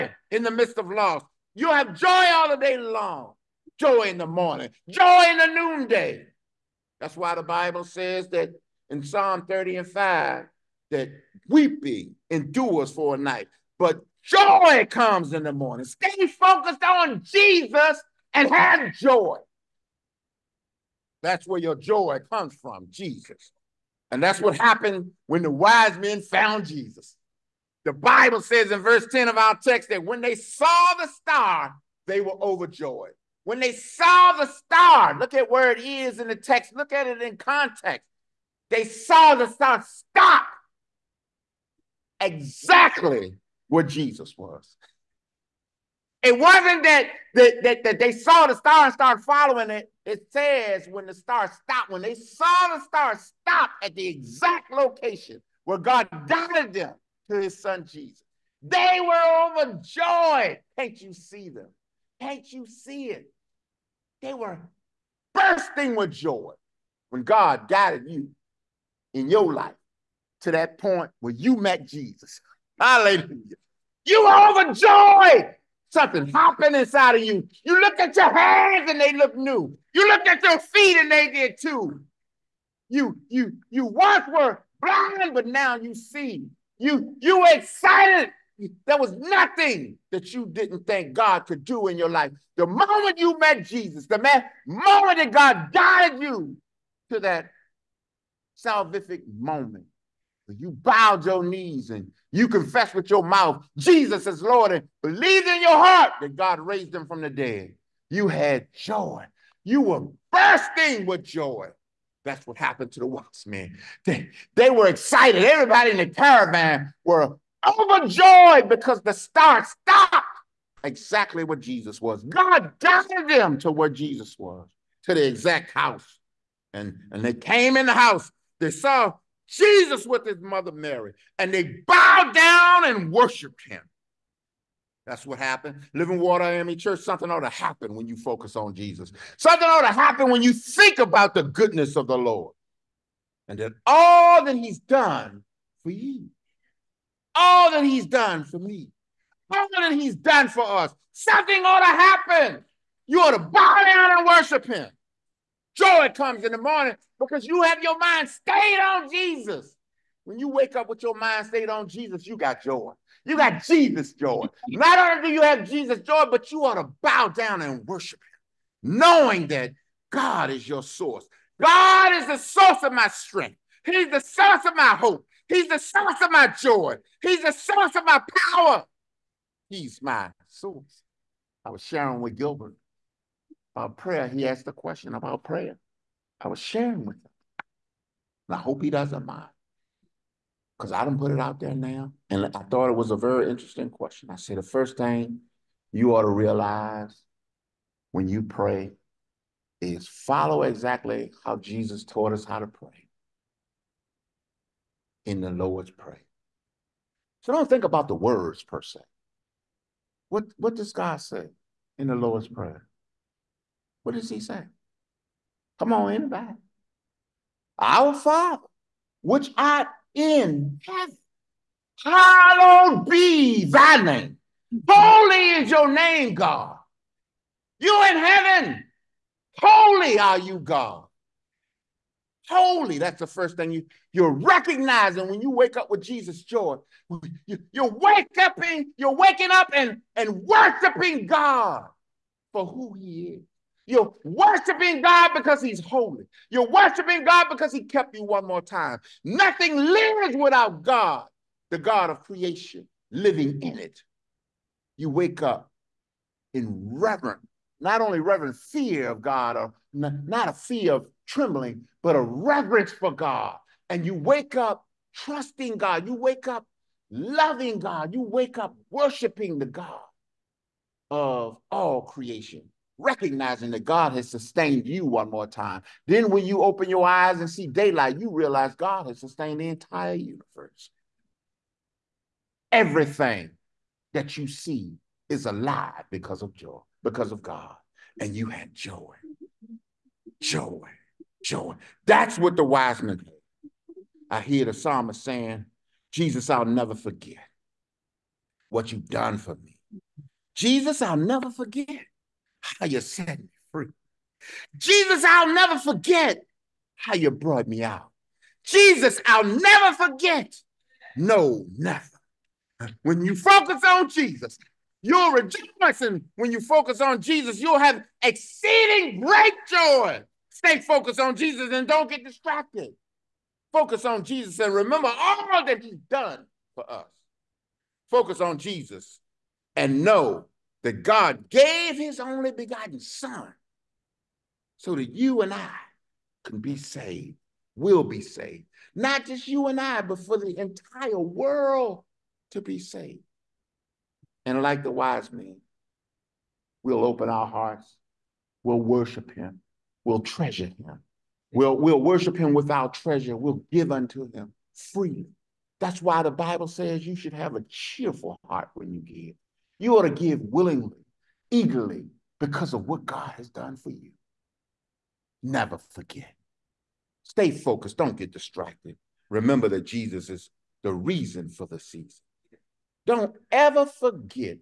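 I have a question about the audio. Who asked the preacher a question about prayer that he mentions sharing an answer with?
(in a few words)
Gilbert.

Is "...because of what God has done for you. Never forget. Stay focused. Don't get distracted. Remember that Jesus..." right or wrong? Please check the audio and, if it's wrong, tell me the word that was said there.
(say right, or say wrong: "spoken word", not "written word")
right.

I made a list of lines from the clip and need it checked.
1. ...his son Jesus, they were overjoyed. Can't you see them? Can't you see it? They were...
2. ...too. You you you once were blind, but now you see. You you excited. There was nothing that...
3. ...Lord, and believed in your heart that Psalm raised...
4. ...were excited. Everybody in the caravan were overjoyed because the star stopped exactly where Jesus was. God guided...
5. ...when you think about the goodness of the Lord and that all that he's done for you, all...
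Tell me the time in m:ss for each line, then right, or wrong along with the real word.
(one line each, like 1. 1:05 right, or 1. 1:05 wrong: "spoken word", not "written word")
1. 0:57 right
2. 1:21 right
3. 1:44 wrong: "God", not "Psalm"
4. 1:54 right
5. 2:20 right.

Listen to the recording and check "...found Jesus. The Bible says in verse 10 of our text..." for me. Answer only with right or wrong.
right.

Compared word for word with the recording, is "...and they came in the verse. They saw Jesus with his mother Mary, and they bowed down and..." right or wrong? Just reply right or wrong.
wrong.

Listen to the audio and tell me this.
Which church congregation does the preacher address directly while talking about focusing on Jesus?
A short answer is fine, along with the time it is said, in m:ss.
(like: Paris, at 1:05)
Living Water AME Church, at 2:15.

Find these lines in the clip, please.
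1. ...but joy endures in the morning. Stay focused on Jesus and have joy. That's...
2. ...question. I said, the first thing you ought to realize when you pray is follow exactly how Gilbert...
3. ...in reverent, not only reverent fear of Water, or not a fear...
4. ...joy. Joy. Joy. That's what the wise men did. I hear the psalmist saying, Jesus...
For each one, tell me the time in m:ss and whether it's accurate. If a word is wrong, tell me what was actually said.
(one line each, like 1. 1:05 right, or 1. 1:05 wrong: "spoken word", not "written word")
1. 0:13 wrong: "comes", not "endures"
2. 3:13 wrong: "Jesus", not "Gilbert"
3. 4:16 wrong: "God", not "Water"
4. 4:48 right.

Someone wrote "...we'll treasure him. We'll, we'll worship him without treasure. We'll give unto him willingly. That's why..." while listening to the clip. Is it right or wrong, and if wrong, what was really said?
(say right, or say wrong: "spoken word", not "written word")
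wrong: "freely", not "willingly".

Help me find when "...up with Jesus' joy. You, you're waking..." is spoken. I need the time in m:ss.
3:55.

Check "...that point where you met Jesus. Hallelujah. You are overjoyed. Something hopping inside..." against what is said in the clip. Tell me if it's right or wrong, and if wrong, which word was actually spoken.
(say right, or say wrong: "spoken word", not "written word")
right.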